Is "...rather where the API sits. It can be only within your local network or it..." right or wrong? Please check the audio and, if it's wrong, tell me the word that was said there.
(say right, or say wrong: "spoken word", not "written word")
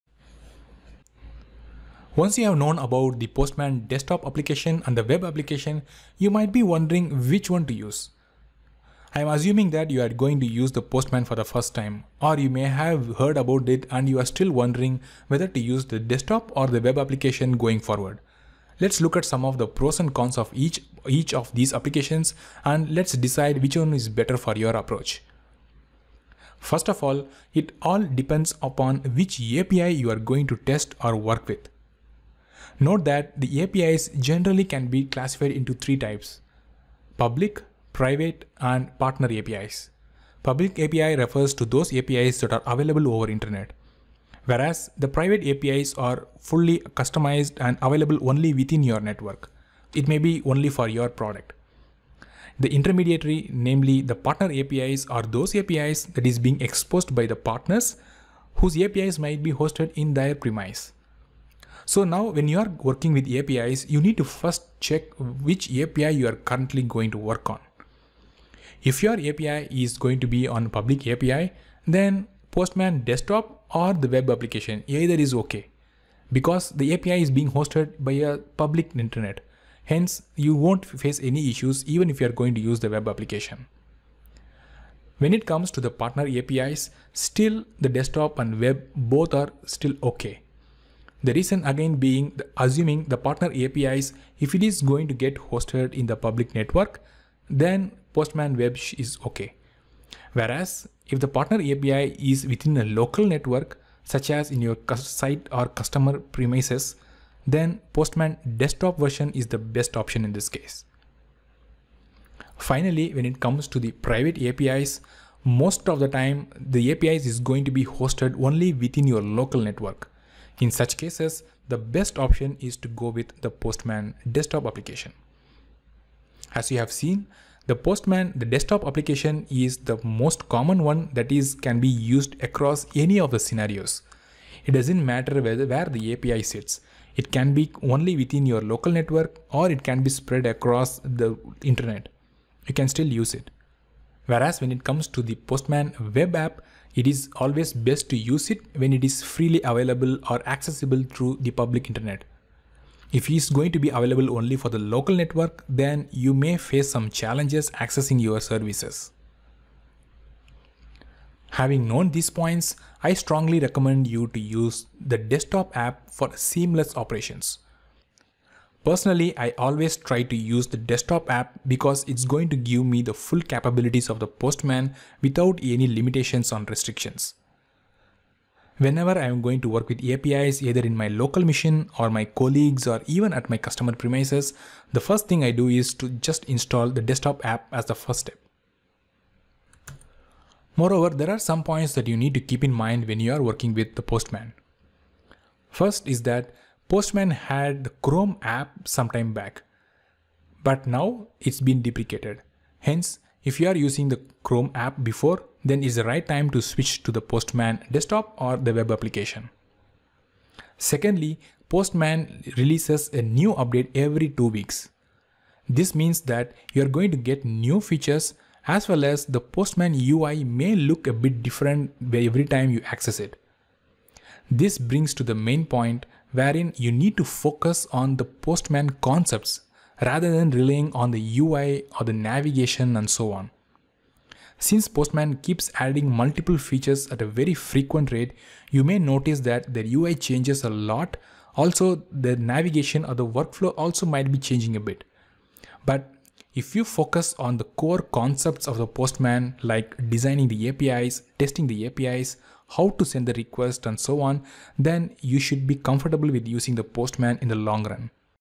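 wrong: "whether", not "rather".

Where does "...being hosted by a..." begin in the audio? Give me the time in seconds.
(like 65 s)
77 s.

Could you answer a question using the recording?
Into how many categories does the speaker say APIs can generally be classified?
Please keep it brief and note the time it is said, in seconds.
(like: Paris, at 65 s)
3, at 35 s.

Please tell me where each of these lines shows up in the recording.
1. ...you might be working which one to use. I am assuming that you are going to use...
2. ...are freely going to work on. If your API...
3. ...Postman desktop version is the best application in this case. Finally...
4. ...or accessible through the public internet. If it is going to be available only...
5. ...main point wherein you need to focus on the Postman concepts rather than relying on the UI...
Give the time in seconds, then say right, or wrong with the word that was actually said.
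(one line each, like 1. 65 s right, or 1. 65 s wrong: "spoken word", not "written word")
1. 6 s wrong: "wondering", not "working"
2. 66 s wrong: "currently", not "freely"
3. 107 s wrong: "option", not "application"
4. 150 s right
5. 225 s right.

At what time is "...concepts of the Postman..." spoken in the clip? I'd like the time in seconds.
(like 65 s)
248 s.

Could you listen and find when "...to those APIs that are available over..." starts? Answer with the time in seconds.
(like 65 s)
41 s.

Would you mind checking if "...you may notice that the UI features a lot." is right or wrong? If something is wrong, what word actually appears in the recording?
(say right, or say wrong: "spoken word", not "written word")
wrong: "changes", not "features".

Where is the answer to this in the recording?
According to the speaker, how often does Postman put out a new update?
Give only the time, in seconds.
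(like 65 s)
213 s.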